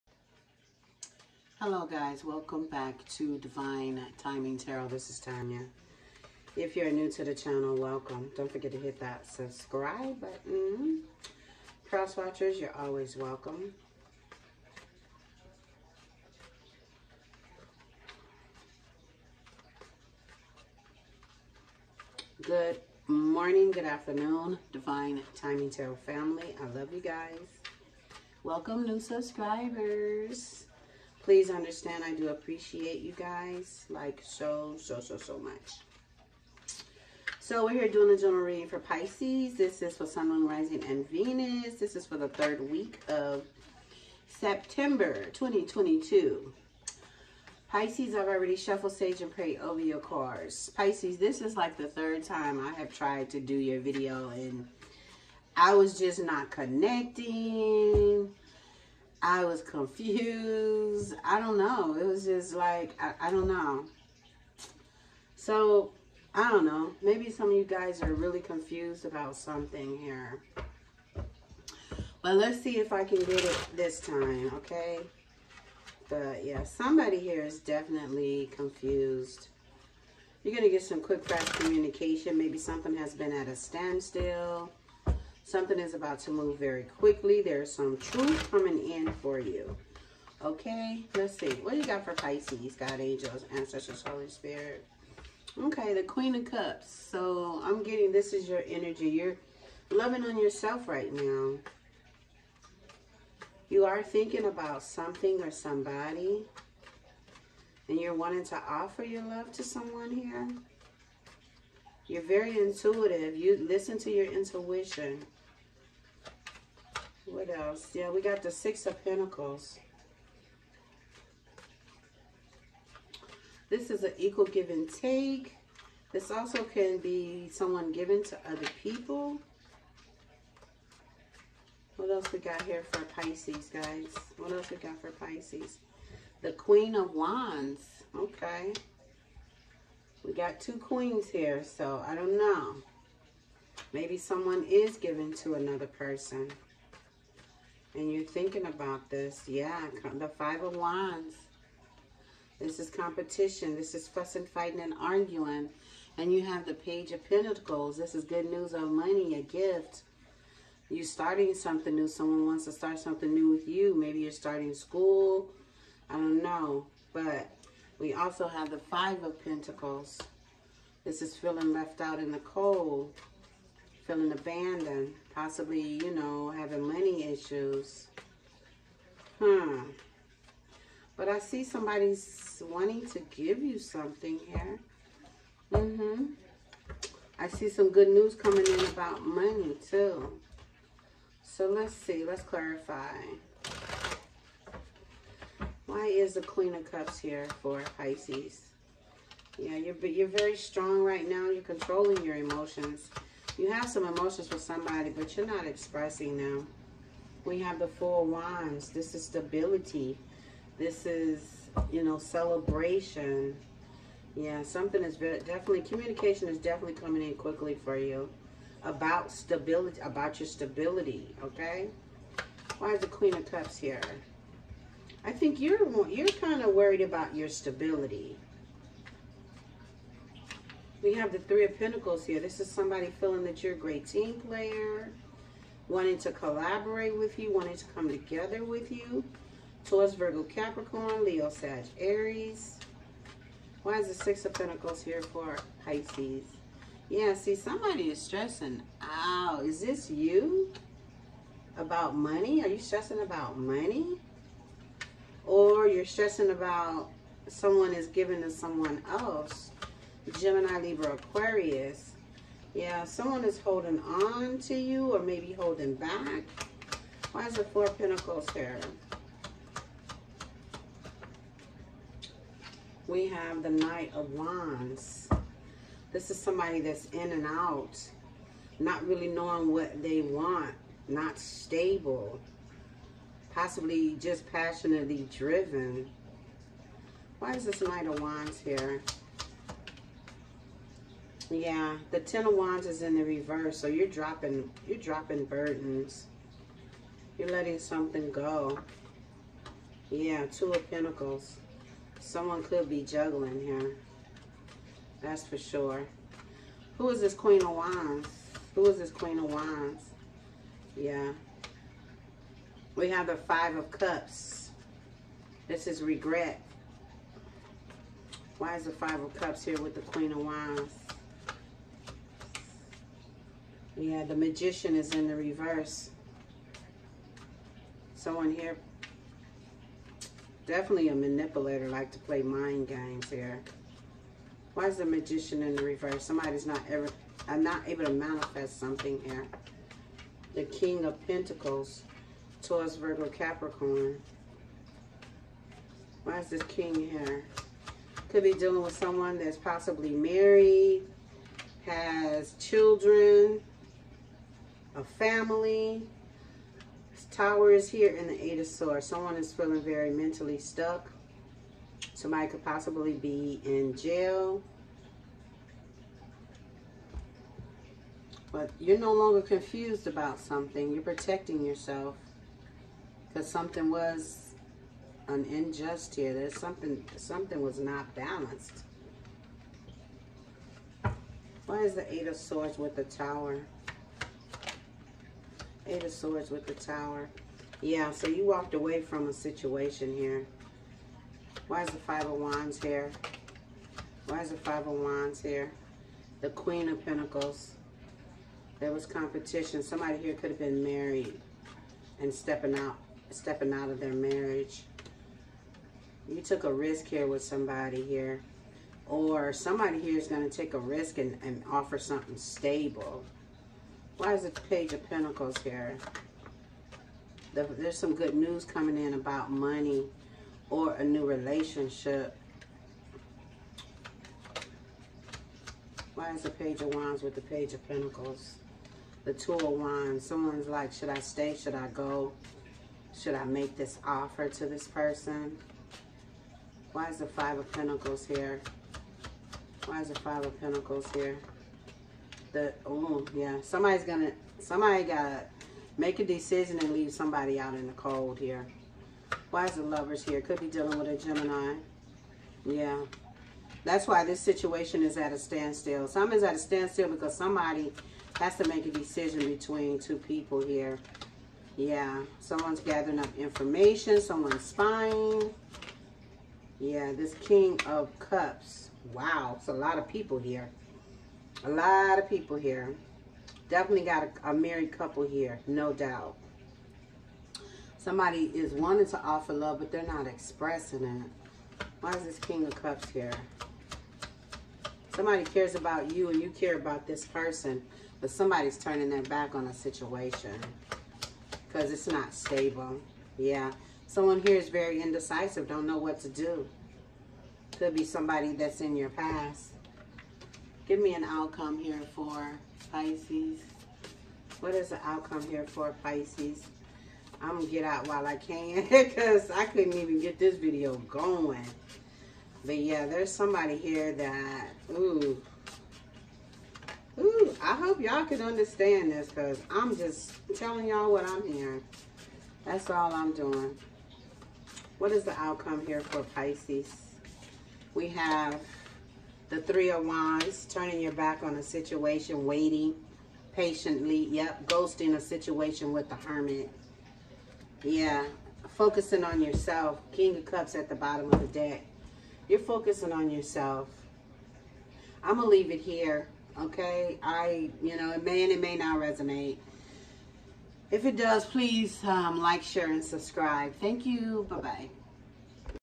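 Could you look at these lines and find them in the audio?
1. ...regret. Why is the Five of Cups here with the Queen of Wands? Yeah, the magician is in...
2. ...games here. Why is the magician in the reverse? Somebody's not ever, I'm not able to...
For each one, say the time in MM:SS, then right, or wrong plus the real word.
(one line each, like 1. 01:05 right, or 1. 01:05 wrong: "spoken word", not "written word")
1. 05:16 right
2. 05:32 right.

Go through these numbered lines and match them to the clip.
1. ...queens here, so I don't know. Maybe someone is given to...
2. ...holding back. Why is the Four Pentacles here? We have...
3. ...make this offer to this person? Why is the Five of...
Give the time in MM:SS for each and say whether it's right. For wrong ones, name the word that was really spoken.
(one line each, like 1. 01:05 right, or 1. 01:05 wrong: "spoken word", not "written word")
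1. 02:20 right
2. 04:25 right
3. 07:13 right.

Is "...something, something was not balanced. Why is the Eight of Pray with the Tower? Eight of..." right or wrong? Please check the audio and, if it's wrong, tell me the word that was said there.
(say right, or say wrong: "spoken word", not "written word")
wrong: "Swords", not "Pray".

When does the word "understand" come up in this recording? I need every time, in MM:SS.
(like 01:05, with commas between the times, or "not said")
00:31, 08:38.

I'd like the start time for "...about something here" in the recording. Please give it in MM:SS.
01:09.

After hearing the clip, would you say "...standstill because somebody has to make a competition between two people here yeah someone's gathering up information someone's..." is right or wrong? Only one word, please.
wrong.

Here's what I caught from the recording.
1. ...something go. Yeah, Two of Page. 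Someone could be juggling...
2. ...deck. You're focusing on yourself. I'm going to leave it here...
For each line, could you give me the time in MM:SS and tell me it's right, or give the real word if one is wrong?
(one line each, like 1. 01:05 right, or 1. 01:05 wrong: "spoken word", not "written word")
1. 04:57 wrong: "Pentacles", not "Page"
2. 09:01 right.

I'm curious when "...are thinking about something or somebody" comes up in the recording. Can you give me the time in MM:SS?
01:43.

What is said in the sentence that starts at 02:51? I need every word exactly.
This is feeling left out in the cold feeling abandoned, possibly, you know, having money issues.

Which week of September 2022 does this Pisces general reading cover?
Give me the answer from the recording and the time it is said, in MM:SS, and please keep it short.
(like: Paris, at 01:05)
Third week, at 00:42.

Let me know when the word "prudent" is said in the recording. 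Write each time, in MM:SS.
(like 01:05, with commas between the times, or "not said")
not said.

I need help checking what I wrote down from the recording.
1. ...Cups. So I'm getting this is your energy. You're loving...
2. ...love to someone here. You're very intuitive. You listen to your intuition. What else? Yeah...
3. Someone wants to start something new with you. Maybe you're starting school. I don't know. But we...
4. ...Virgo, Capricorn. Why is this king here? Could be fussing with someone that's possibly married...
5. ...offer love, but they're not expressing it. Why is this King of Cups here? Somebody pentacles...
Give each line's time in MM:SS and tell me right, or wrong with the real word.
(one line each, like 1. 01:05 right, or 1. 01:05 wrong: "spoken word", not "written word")
1. 01:36 right
2. 01:49 right
3. 02:42 right
4. 05:42 wrong: "dealing", not "fussing"
5. 07:59 wrong: "cares", not "pentacles".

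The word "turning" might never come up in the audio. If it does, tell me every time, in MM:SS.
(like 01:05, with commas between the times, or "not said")
08:08, 08:50.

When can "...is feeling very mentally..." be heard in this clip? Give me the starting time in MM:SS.
05:59.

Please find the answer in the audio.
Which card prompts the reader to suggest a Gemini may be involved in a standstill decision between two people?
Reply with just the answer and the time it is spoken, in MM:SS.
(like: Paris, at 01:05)
The Lovers, at 07:29.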